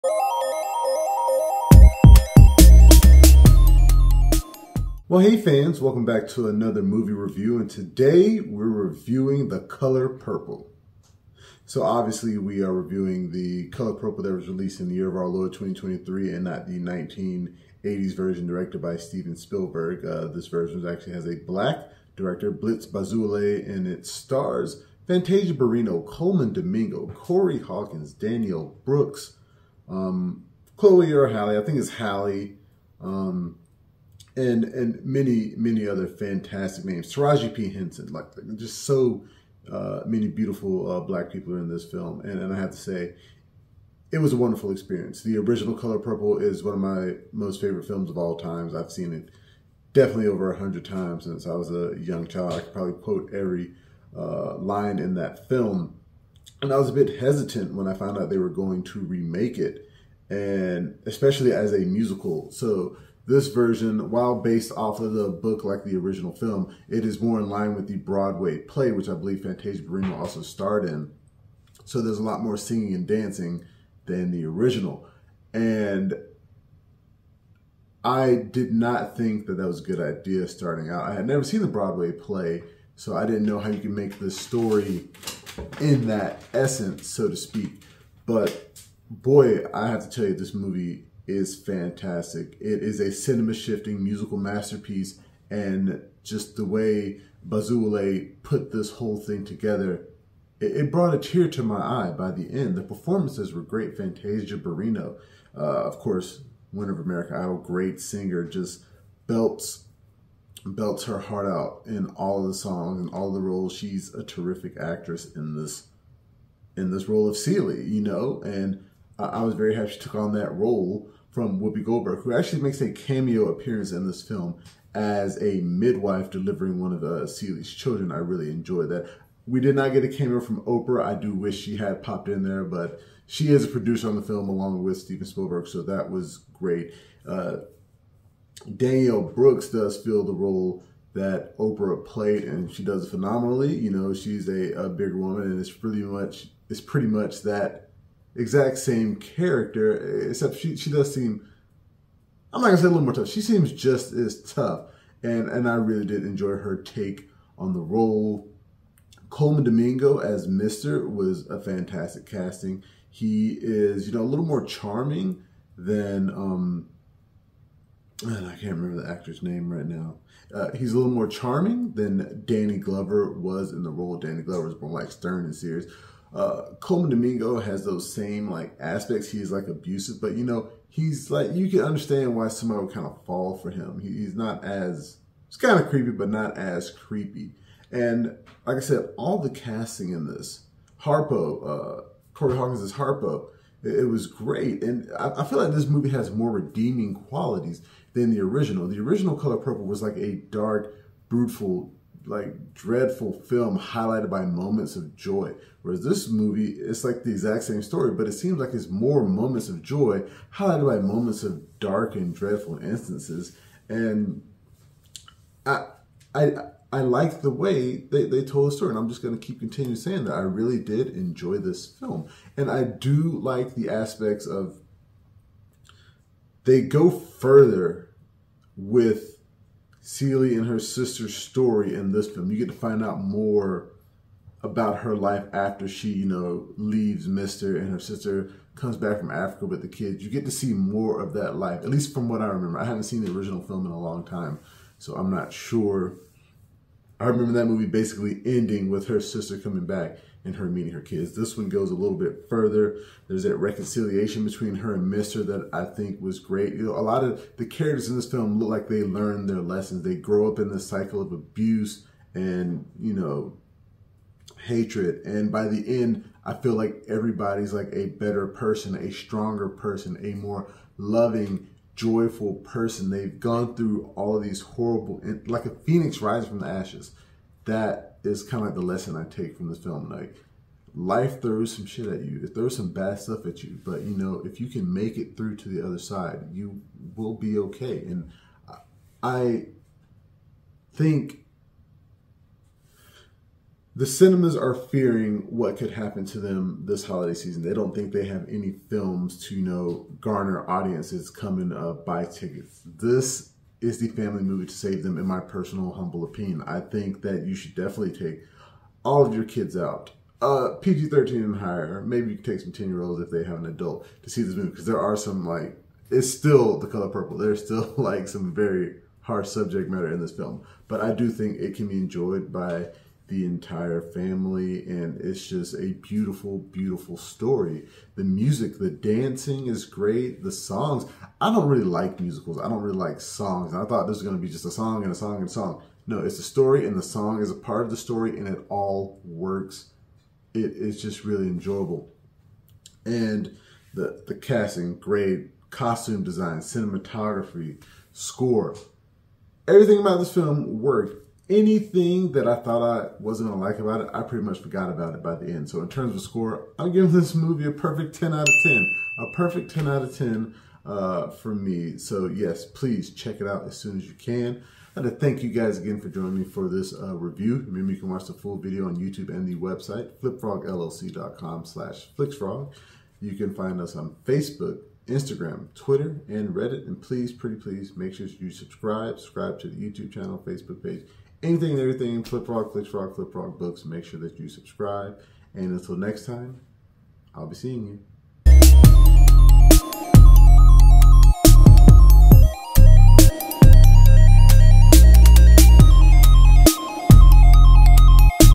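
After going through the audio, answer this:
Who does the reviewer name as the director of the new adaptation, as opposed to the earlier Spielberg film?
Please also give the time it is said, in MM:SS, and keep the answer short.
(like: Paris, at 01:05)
Blitz Bazule, at 00:22.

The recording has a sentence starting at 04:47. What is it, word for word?
And I think the cinemas are fearing what could happen to them this holiday season.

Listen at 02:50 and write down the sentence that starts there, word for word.
Uh, he's a little more charming than Danny Glover was in the role.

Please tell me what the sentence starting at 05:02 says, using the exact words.
This is the family movie to save them, in my personal humble opinion.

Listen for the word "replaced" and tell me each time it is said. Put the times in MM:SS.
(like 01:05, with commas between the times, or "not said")
not said.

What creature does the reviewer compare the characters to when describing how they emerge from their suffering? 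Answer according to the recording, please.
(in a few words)
phoenix.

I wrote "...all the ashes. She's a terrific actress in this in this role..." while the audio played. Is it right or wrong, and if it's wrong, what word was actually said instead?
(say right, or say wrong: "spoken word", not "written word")
wrong: "roles", not "ashes".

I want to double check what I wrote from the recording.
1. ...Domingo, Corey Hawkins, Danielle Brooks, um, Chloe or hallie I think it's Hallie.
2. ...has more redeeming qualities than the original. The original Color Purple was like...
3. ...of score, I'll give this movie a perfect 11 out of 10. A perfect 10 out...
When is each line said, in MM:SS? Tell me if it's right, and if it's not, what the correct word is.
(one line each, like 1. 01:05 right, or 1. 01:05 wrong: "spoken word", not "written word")
1. 00:26 right
2. 03:16 right
3. 05:56 wrong: "10", not "11".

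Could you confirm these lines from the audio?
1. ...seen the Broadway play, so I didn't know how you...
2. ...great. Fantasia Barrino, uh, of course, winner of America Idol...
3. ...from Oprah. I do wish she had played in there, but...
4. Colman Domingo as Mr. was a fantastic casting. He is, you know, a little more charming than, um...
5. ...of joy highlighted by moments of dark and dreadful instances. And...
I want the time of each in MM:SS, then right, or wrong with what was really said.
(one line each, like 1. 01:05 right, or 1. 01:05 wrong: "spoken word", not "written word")
1. 01:21 right
2. 01:43 right
3. 02:10 wrong: "popped", not "played"
4. 02:39 right
5. 03:29 right.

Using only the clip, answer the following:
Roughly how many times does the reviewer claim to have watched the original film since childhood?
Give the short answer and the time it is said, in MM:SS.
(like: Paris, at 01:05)
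over 100, at 00:50.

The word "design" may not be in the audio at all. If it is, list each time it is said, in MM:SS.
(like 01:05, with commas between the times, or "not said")
05:46.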